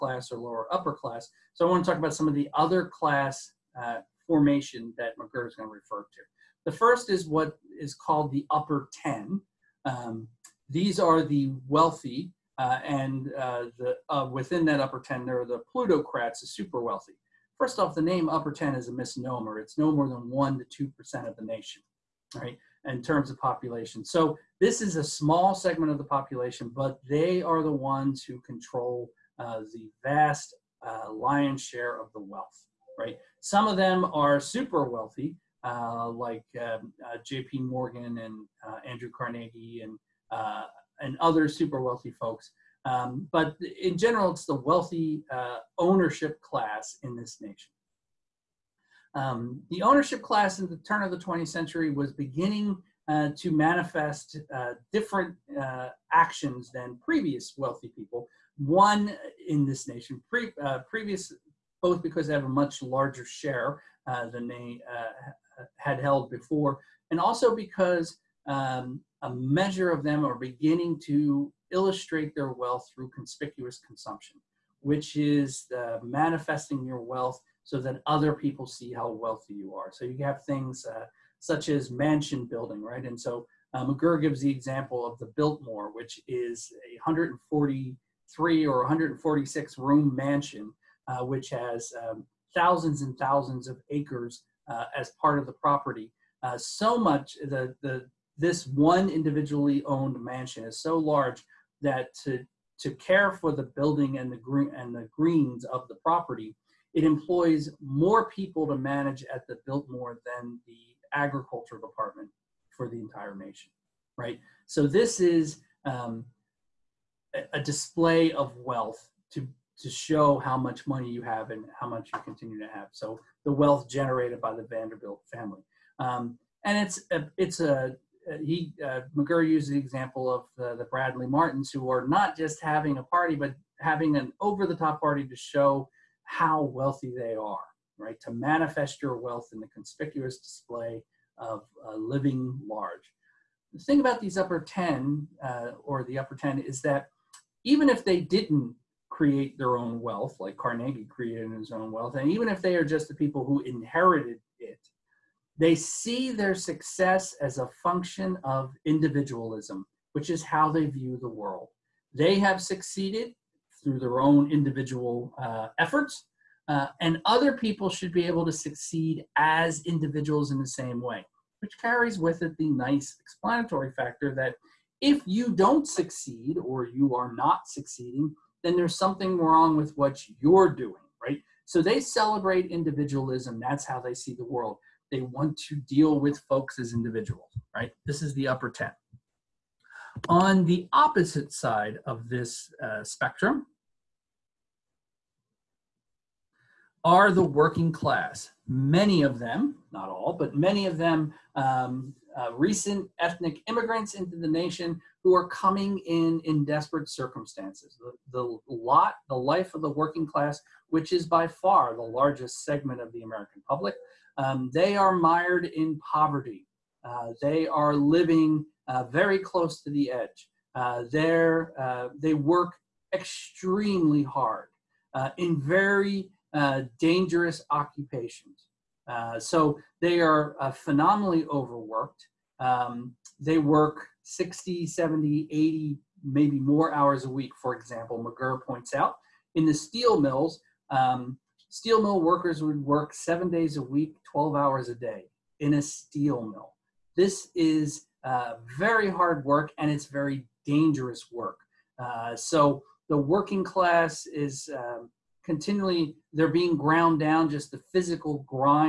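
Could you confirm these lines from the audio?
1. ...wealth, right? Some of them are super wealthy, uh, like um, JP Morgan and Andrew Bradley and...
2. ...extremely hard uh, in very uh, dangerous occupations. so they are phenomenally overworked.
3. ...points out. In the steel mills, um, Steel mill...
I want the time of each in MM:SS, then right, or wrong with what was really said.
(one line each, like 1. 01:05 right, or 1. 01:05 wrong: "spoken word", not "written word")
1. 00:32 wrong: "Carnegie", not "Bradley"
2. 03:43 right
3. 03:58 right.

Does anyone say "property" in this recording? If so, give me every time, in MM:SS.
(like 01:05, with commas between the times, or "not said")
01:35, 01:45.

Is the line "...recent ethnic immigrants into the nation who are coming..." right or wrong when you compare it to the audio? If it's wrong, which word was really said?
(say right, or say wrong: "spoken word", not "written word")
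right.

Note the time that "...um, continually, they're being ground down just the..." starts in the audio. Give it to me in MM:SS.
04:14.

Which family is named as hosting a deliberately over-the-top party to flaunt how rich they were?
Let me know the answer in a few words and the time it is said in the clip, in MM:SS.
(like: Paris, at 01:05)
Bradley Martins, at 02:10.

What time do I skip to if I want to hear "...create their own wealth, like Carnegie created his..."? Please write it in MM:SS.
02:29.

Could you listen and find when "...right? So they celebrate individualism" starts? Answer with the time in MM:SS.
03:01.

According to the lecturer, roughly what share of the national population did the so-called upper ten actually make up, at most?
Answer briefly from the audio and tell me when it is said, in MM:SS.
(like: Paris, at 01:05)
1% to 2%, at 00:20.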